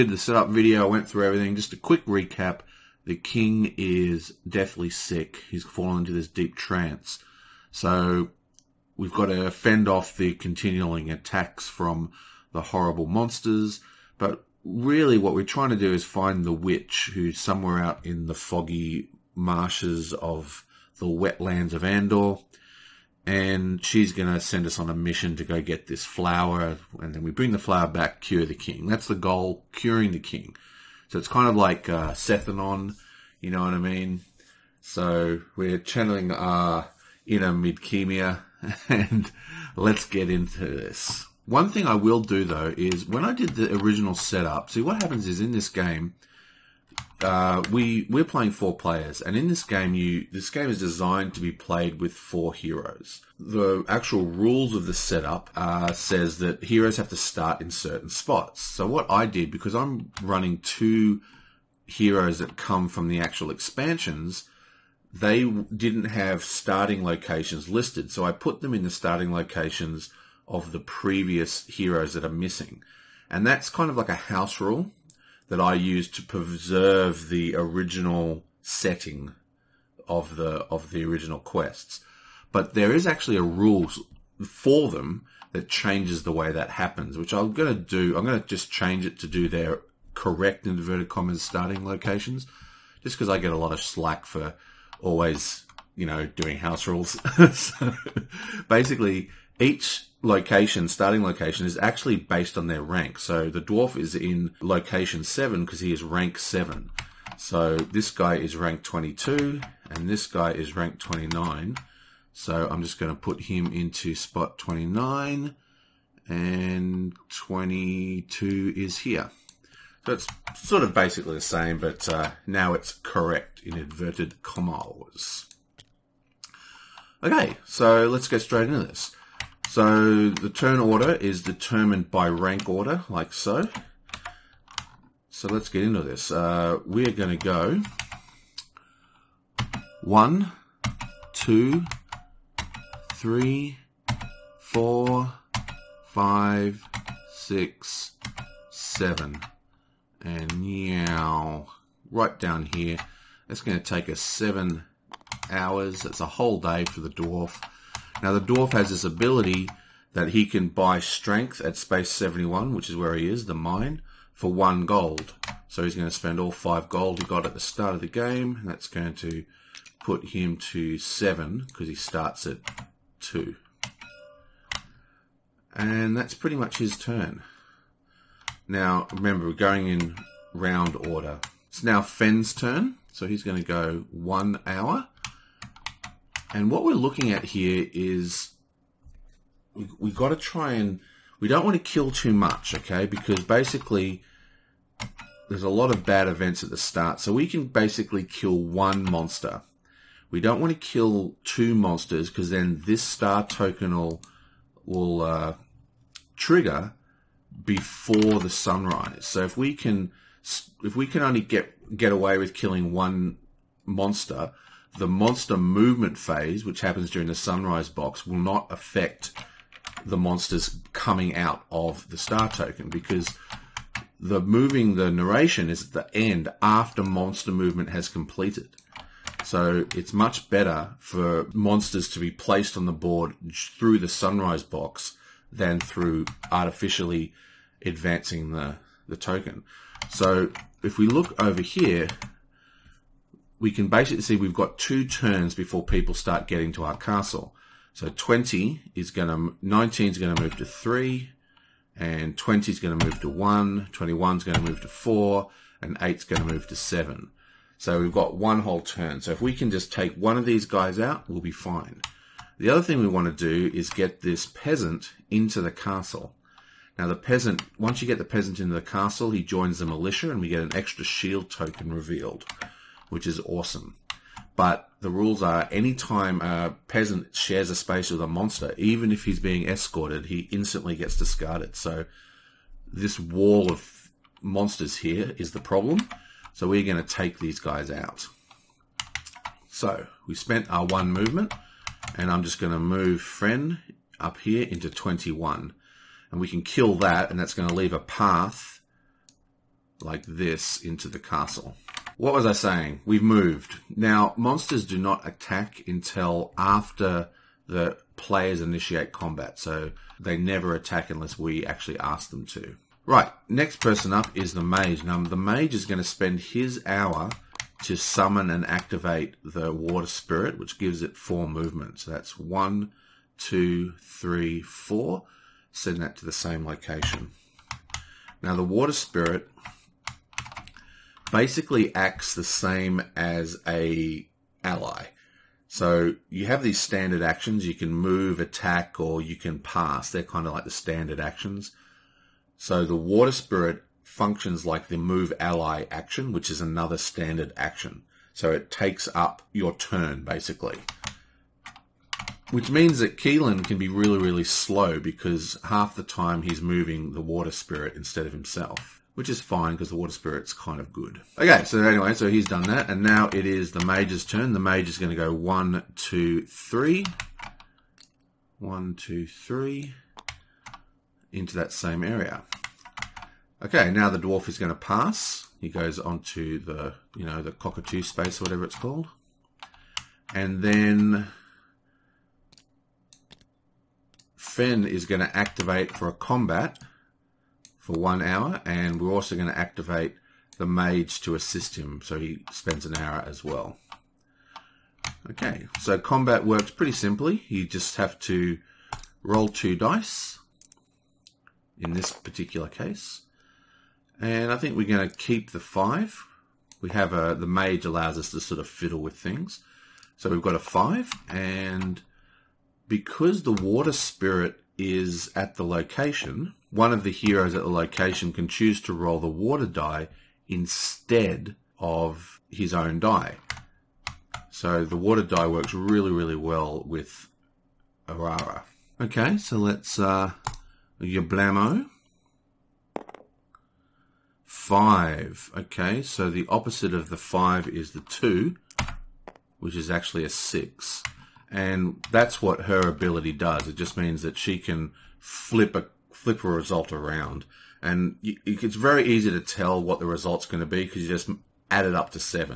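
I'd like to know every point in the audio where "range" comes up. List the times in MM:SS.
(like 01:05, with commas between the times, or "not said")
not said.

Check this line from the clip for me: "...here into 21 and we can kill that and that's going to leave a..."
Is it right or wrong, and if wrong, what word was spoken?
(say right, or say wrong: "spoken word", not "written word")
right.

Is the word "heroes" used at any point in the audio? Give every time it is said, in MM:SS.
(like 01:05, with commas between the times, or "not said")
00:52, 00:56, 01:01, 01:11, 06:57.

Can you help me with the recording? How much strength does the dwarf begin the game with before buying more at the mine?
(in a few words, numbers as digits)
2.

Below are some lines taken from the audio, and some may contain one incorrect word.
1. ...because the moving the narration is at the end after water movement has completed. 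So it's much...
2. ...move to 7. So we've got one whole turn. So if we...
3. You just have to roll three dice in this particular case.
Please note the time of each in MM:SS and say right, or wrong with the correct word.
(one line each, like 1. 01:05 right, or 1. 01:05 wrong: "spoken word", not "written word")
1. 03:42 wrong: "monster", not "water"
2. 04:16 right
3. 06:37 wrong: "two", not "three".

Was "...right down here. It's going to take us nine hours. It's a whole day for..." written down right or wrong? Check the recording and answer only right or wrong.
wrong.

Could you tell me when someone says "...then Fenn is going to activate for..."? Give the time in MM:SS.
06:20.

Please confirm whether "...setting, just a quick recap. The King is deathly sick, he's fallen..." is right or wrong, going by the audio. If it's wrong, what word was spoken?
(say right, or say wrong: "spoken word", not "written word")
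wrong: "everything", not "setting".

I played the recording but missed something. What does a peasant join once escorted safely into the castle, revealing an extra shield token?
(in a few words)
The militia.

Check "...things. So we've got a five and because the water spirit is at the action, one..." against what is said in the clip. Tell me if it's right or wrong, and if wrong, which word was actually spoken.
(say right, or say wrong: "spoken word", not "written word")
wrong: "location", not "action".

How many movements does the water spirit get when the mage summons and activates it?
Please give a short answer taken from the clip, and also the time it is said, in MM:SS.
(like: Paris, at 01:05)
4, at 05:21.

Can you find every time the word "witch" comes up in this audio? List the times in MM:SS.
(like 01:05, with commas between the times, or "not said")
00:16.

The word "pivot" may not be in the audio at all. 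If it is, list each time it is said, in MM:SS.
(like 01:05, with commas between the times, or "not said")
not said.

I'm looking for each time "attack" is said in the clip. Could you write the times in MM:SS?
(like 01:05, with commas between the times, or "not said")
00:11, 05:05, 05:10, 05:38.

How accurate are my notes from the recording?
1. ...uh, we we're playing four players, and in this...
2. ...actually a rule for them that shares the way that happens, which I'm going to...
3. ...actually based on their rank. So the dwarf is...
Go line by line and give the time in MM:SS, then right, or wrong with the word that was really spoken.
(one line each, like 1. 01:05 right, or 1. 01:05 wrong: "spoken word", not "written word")
1. 00:47 right
2. 01:23 wrong: "changes", not "shares"
3. 01:41 right.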